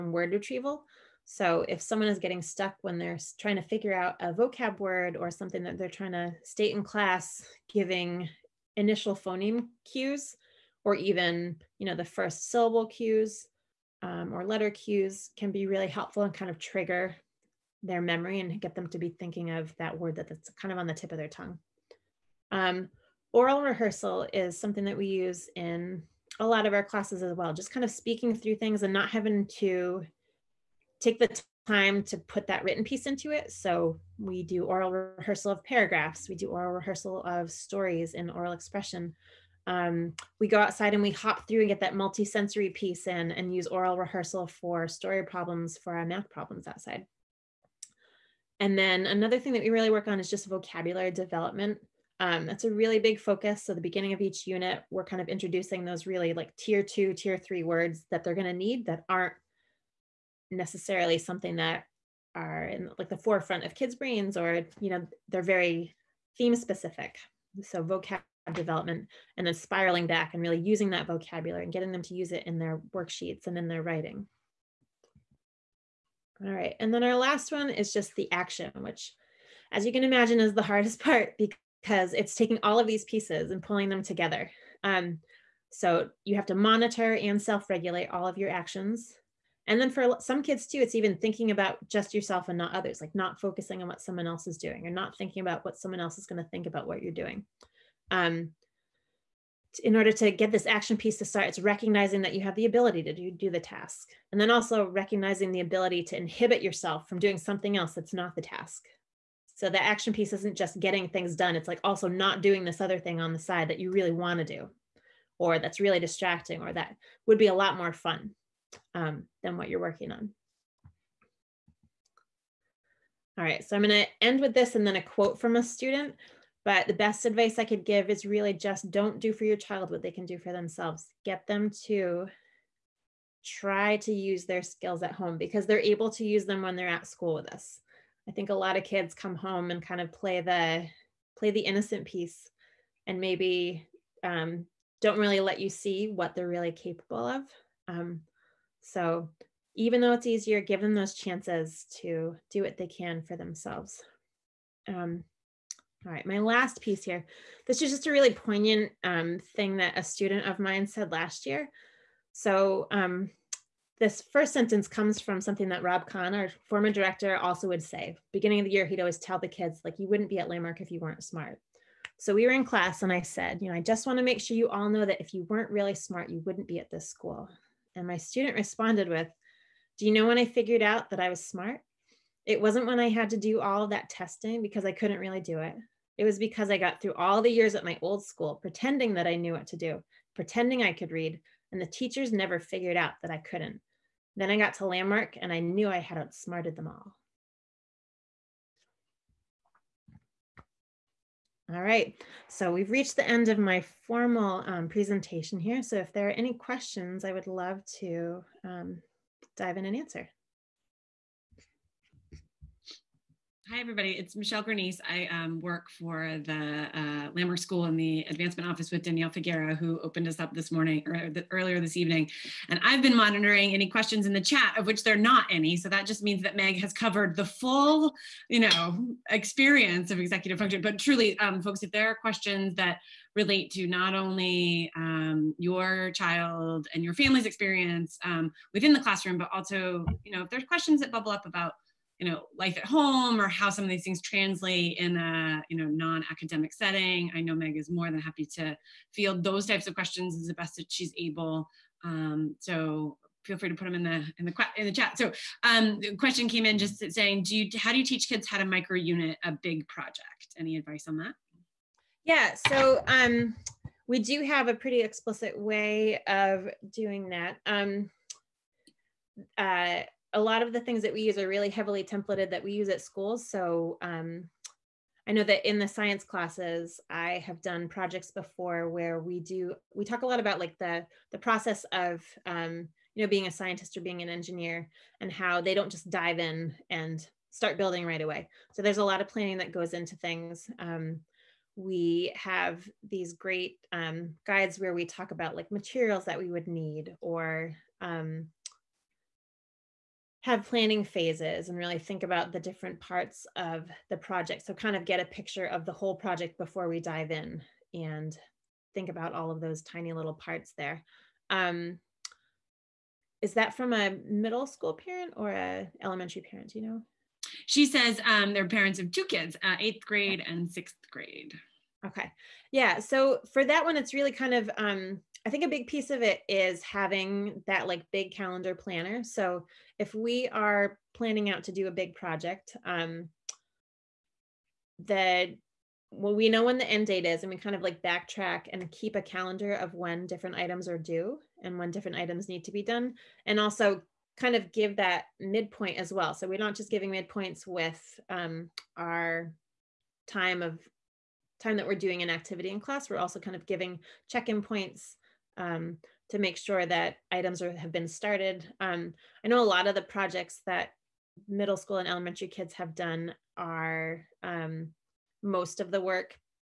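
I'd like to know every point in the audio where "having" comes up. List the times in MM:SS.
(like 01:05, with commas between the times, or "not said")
00:29, 05:26.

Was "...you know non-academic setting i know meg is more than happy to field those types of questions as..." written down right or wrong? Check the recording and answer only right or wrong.
right.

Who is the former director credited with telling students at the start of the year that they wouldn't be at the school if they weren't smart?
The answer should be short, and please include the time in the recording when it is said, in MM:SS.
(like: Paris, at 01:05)
Rob Kahn, at 02:45.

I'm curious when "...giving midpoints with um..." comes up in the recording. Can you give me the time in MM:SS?
05:46.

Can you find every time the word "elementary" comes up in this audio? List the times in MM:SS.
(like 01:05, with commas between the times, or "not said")
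05:16, 06:02.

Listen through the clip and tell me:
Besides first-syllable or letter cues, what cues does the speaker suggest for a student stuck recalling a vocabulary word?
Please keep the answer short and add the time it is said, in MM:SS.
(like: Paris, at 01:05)
initial phoneme cues, at 00:08.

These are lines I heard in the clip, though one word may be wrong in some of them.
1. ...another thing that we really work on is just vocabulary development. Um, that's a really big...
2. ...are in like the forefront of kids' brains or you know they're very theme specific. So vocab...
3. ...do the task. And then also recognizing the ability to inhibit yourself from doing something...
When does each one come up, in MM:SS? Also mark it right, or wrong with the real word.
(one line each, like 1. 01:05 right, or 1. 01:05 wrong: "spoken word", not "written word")
1. 00:49 right
2. 01:02 right
3. 01:43 right.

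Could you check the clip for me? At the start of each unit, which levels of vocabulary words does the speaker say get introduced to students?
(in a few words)
tier two, tier three.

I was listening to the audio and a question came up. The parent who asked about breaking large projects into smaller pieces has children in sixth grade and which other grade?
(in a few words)
eighth grade.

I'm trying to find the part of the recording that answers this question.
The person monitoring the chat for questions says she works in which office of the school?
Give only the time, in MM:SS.
03:38.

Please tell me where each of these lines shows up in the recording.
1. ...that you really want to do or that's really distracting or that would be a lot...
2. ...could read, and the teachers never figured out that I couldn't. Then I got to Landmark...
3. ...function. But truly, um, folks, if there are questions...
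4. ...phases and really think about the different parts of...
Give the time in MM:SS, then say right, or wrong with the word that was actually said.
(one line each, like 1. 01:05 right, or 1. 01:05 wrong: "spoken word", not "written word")
1. 01:53 right
2. 03:10 right
3. 03:50 right
4. 05:01 right.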